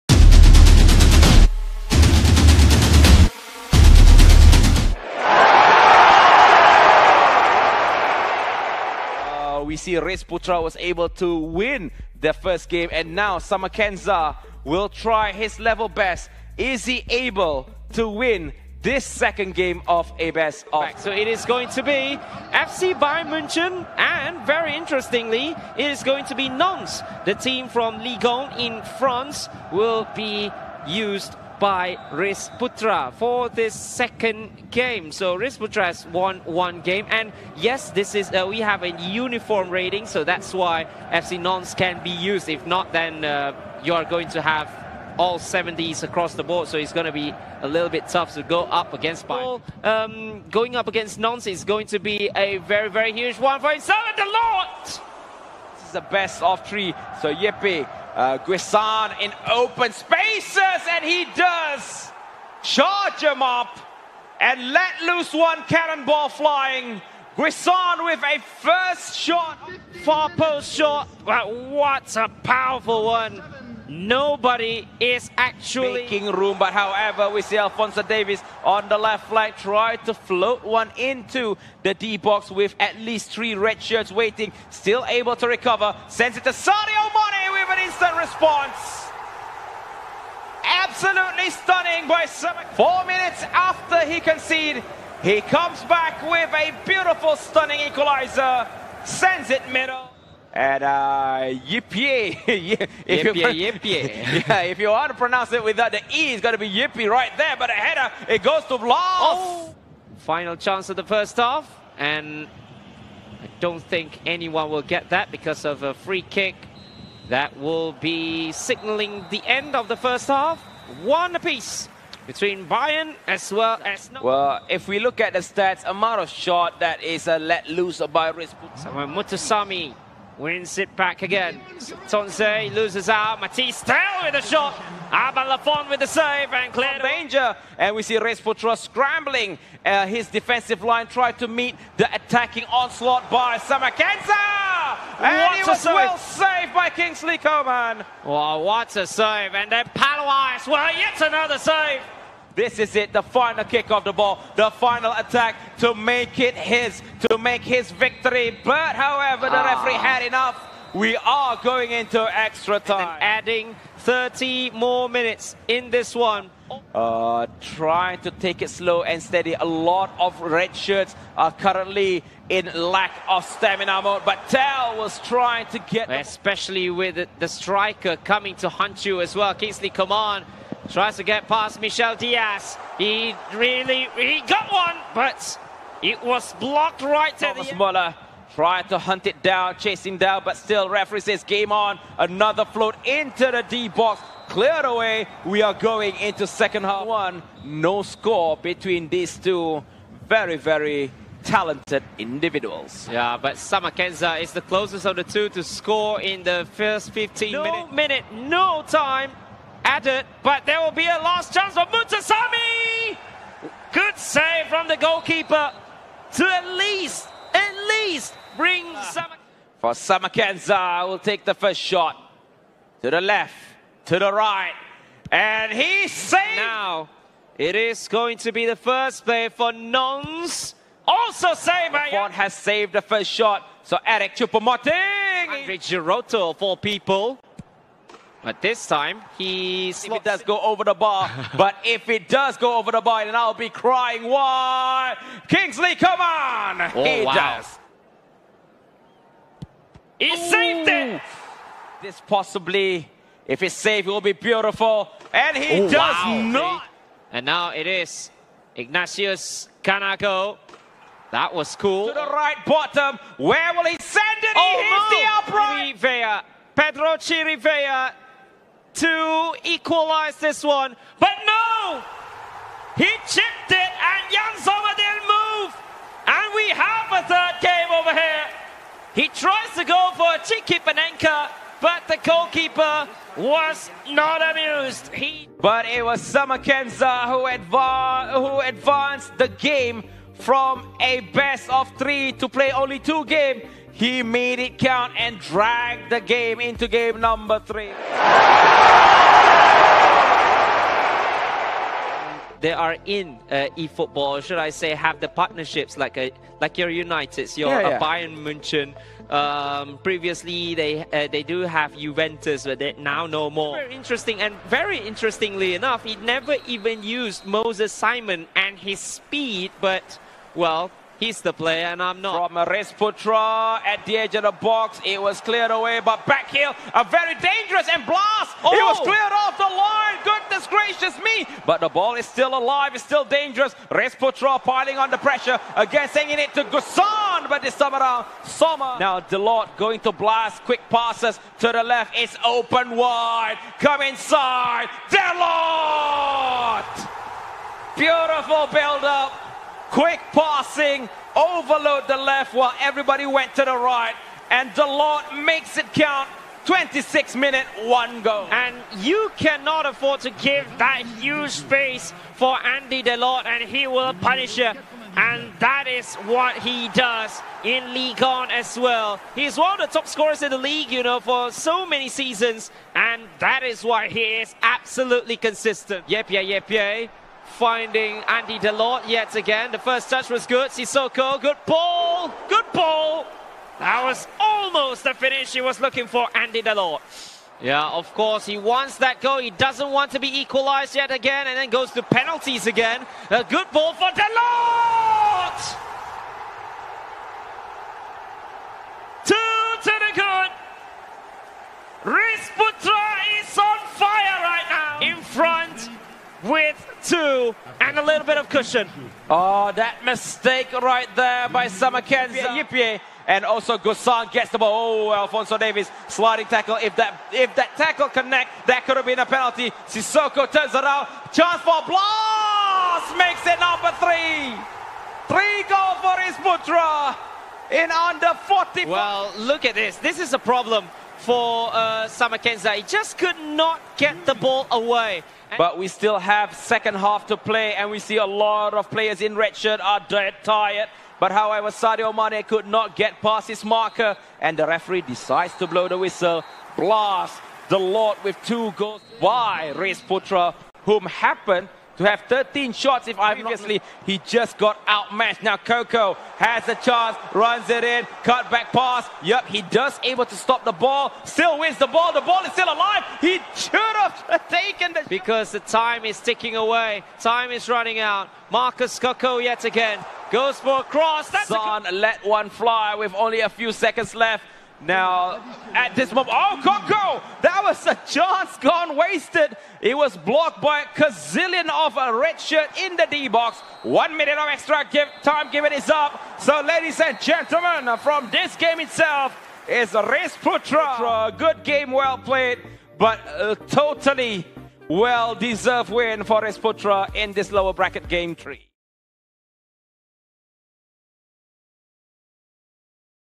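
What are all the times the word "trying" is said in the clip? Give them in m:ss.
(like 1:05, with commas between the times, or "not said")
2:47, 2:55.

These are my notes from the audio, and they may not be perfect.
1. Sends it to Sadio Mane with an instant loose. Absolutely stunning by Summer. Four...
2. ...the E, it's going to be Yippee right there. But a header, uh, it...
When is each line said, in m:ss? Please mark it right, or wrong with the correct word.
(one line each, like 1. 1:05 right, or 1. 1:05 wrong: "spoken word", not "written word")
1. 1:26 wrong: "response", not "loose"
2. 1:45 right.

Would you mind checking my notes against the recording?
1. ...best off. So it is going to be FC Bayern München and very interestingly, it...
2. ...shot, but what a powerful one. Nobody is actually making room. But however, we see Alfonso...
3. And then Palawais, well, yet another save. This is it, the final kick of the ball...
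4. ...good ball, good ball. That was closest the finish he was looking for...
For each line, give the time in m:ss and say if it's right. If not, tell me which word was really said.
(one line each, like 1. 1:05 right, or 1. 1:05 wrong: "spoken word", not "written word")
1. 0:20 right
2. 1:10 right
3. 2:29 right
4. 6:21 wrong: "almost", not "closest".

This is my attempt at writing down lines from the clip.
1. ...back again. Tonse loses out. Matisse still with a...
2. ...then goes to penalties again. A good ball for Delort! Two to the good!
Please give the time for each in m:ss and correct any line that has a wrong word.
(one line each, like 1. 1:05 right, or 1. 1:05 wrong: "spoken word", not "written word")
1. 2:10 right
2. 6:31 right.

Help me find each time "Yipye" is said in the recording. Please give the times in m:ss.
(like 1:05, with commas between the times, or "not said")
6:52.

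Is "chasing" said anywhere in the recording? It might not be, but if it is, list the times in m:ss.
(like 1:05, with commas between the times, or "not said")
3:09.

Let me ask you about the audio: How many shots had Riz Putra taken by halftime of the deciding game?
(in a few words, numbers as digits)
13.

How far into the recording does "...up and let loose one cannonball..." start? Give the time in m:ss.
1:03.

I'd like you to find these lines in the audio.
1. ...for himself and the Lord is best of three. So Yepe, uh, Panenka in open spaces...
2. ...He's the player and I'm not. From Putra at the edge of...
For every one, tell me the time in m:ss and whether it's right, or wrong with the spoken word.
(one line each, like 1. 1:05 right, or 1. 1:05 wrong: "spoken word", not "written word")
1. 0:53 wrong: "Guessand", not "Panenka"
2. 5:21 right.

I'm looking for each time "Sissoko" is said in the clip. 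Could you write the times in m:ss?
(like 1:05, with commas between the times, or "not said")
6:20, 6:59.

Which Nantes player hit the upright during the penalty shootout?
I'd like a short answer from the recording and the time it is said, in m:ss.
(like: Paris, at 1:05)
Ignatius Ganago, at 4:18.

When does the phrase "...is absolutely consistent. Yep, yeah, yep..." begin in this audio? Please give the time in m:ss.
6:14.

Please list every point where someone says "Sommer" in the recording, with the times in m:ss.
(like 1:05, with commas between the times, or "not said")
4:34, 5:38.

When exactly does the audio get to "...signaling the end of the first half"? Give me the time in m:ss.
1:58.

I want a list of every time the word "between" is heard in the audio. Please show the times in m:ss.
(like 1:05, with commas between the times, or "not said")
2:02, 3:18.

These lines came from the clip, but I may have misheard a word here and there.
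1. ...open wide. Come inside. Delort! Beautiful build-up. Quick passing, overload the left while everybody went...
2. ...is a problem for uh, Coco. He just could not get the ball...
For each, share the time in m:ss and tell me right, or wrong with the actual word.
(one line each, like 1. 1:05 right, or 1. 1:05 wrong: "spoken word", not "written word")
1. 5:42 right
2. 7:10 wrong: "Samakenza", not "Coco".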